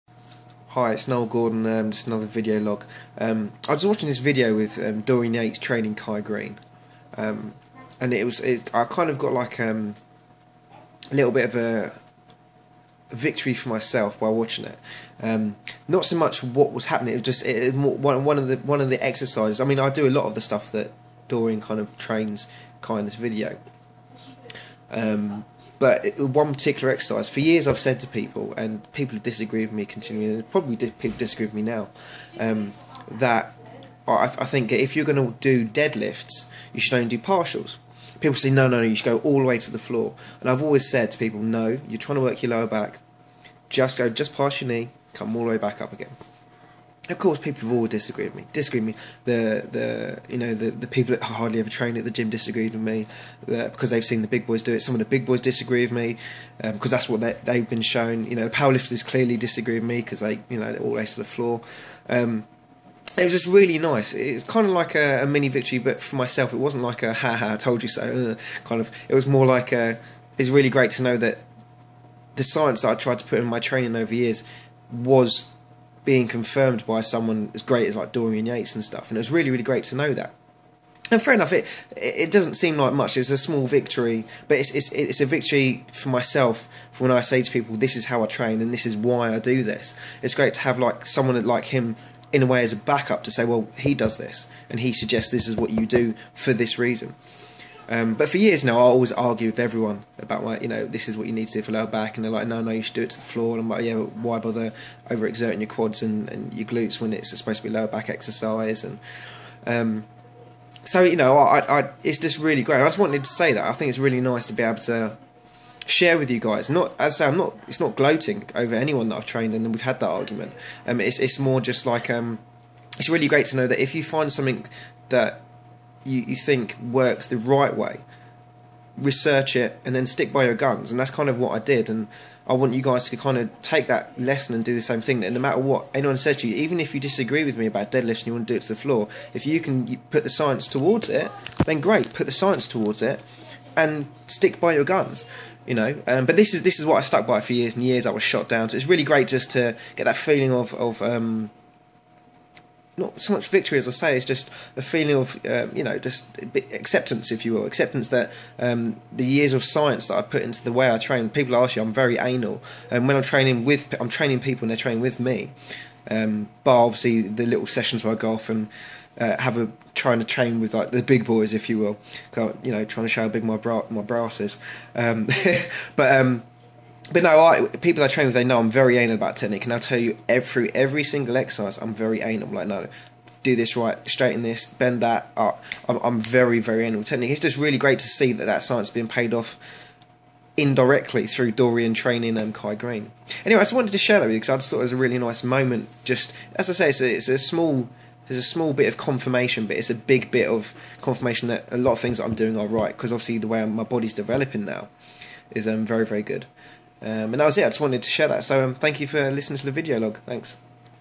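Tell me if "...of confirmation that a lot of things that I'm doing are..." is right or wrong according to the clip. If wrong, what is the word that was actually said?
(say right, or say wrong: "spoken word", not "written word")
right.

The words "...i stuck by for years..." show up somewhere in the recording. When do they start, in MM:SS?
02:26.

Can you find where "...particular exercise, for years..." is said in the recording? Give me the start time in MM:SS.
00:26.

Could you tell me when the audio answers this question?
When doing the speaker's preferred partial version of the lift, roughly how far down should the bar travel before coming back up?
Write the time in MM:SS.
00:44.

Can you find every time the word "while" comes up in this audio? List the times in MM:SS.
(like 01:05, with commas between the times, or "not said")
00:14.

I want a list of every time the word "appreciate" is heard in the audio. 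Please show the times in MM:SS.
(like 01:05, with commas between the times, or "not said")
not said.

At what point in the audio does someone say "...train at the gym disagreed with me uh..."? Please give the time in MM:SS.
00:51.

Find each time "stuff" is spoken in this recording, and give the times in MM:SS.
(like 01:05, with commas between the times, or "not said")
00:20, 01:18.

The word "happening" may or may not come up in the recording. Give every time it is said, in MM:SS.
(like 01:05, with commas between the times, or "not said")
00:16.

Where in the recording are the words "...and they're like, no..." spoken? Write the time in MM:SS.
01:42.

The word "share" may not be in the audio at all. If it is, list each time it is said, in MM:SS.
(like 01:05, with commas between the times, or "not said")
01:55, 03:13, 03:28.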